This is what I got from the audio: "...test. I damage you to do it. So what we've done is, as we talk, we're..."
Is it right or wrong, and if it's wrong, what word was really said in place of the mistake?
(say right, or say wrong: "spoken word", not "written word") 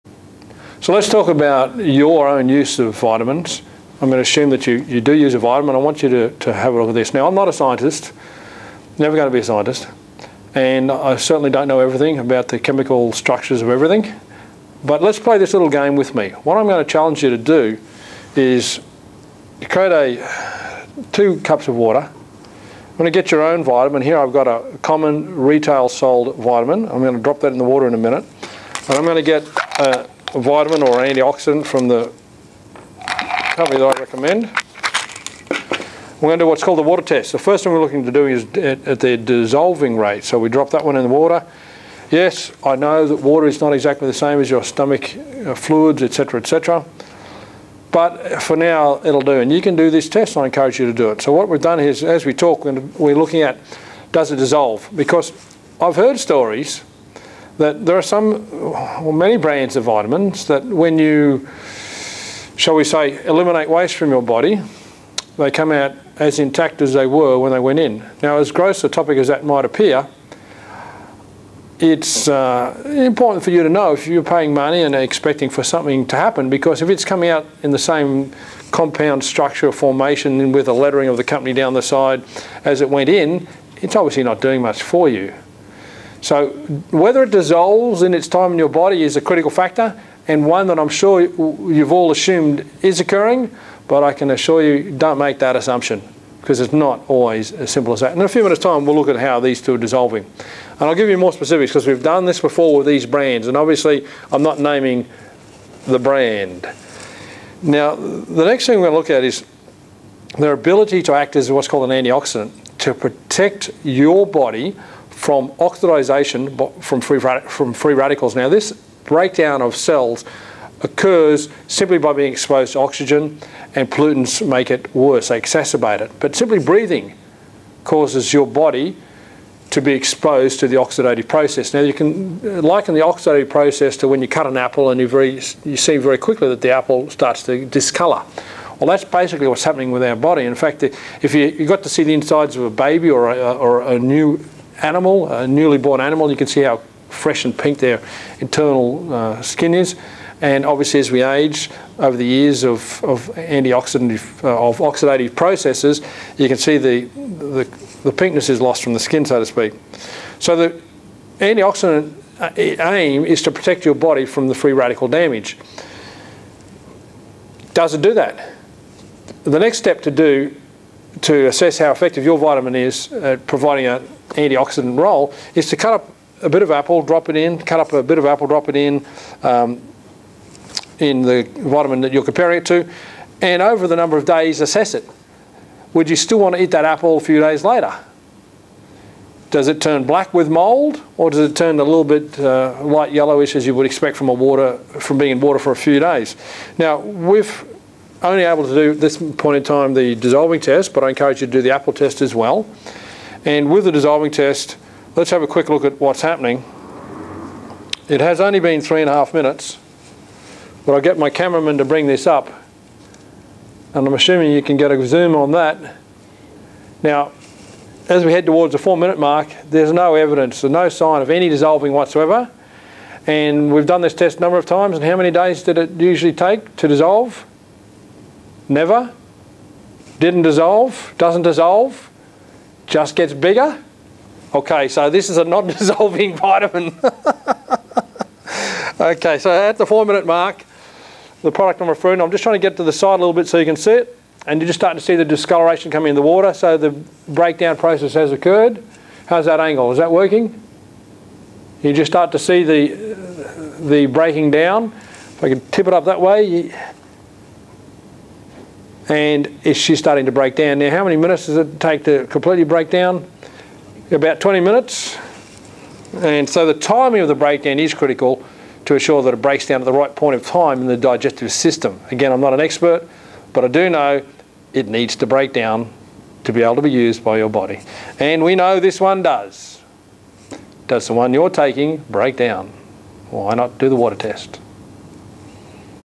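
wrong: "encourage", not "damage".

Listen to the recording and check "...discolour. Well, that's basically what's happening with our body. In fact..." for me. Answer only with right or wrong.
right.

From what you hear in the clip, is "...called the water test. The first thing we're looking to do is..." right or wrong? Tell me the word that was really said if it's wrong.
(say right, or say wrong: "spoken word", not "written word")
right.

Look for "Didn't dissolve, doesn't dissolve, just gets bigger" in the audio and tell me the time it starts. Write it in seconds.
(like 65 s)
230 s.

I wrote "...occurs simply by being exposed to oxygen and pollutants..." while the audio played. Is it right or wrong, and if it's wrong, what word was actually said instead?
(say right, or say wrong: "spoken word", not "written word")
right.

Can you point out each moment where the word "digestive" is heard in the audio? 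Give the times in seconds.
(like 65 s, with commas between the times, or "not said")
270 s.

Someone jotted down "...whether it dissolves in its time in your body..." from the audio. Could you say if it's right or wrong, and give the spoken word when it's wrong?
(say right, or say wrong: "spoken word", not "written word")
right.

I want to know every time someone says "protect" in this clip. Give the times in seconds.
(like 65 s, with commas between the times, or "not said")
112 s, 163 s.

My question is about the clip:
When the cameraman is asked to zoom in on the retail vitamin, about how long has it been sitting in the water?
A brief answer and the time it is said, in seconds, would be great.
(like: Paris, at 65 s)
3 and a half minutes, at 208 s.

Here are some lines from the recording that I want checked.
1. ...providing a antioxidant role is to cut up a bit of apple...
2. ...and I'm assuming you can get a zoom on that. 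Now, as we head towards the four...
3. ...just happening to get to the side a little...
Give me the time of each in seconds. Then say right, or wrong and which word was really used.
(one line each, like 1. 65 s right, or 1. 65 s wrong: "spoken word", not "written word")
1. 173 s right
2. 213 s right
3. 242 s wrong: "trying", not "happening".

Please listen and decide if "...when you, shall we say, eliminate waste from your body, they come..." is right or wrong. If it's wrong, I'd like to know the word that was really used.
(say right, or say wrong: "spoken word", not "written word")
right.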